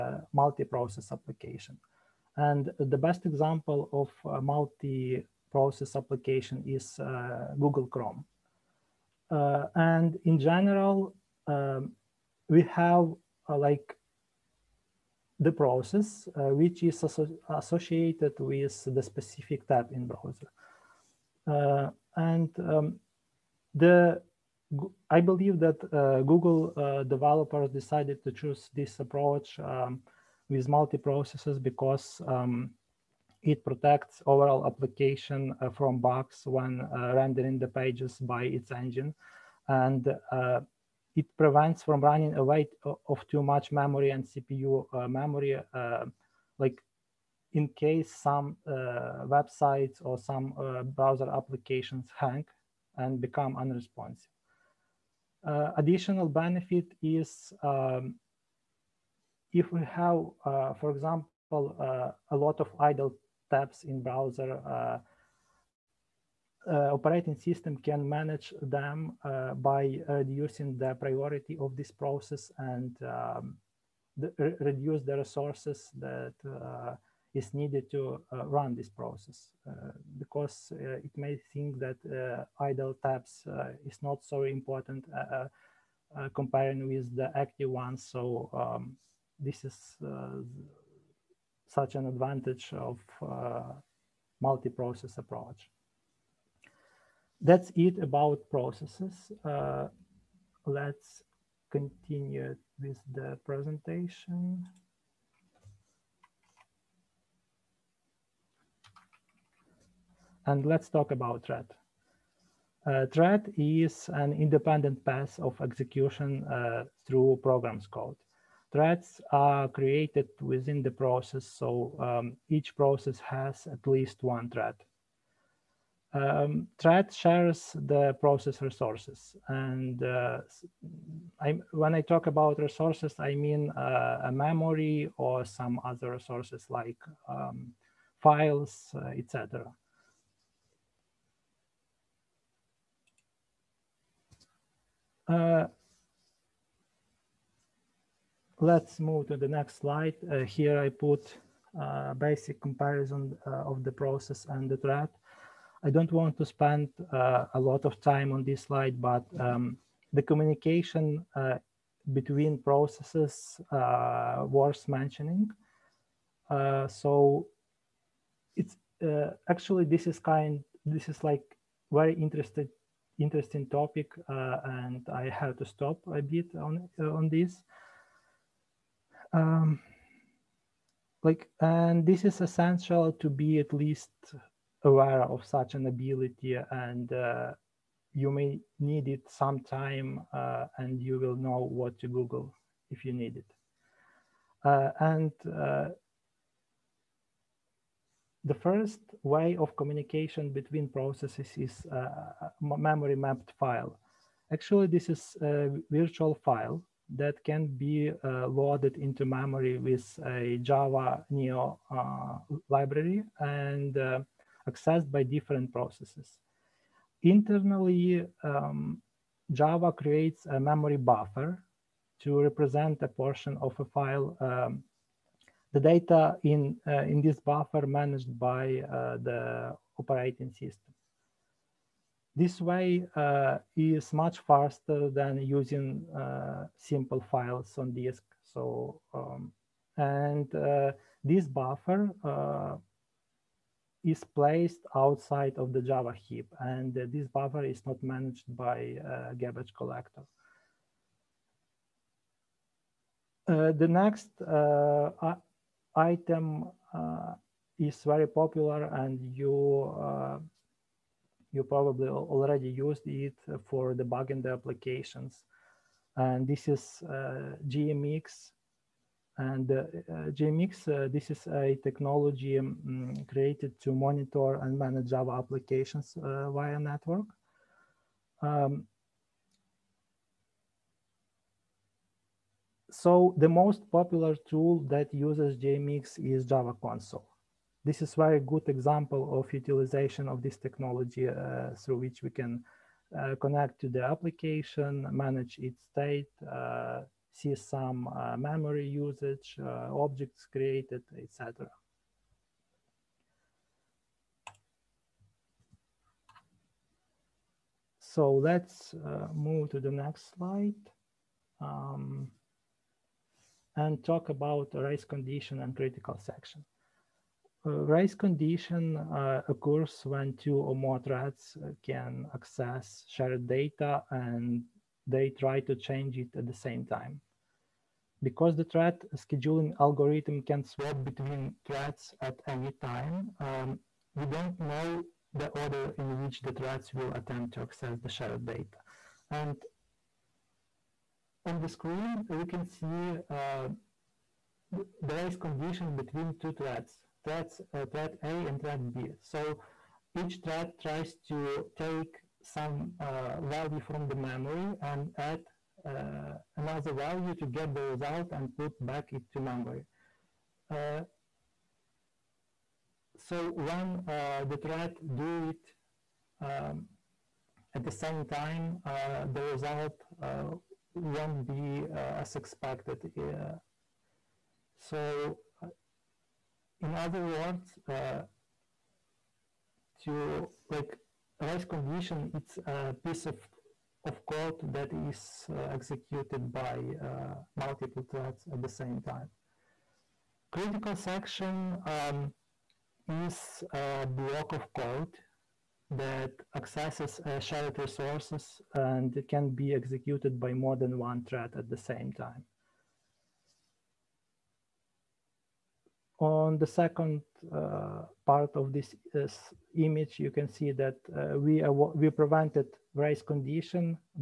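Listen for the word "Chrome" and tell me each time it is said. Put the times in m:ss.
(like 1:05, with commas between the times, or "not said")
0:07.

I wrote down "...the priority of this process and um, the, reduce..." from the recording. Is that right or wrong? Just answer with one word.
right.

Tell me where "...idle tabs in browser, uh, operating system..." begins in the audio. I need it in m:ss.
1:02.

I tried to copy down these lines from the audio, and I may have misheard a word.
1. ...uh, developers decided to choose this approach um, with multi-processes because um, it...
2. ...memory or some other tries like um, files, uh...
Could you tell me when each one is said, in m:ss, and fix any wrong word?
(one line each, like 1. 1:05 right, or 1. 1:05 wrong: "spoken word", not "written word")
1. 0:26 right
2. 2:14 wrong: "resources", not "tries".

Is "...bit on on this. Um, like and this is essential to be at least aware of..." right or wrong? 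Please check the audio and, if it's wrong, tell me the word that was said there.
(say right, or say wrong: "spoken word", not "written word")
right.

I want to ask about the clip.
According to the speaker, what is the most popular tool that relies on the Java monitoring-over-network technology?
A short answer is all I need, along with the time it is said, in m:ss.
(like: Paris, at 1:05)
Java console, at 4:46.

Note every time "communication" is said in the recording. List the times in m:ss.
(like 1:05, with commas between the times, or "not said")
2:40, 3:19.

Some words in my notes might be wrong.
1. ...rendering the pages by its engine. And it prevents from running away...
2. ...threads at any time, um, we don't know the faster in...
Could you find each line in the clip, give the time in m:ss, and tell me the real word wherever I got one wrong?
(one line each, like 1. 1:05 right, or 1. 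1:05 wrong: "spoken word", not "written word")
1. 0:37 right
2. 5:31 wrong: "order", not "faster".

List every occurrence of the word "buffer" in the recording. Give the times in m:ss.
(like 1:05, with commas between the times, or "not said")
3:40, 3:47, 4:01, 4:07.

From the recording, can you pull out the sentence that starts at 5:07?
So let's uh, move to the next slide.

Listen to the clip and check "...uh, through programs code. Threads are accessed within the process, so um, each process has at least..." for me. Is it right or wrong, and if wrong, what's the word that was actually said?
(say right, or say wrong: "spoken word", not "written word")
wrong: "created", not "accessed".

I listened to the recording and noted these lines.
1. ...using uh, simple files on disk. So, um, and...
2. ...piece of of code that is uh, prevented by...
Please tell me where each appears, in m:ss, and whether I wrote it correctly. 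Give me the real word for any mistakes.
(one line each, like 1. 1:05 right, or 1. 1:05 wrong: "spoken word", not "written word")
1. 3:55 right
2. 6:23 wrong: "executed", not "prevented".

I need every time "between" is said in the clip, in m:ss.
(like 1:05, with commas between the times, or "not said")
2:42, 3:20, 5:31, 5:45.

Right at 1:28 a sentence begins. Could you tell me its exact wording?
So um, this is such an advantage of multi-process approach that's it about processes.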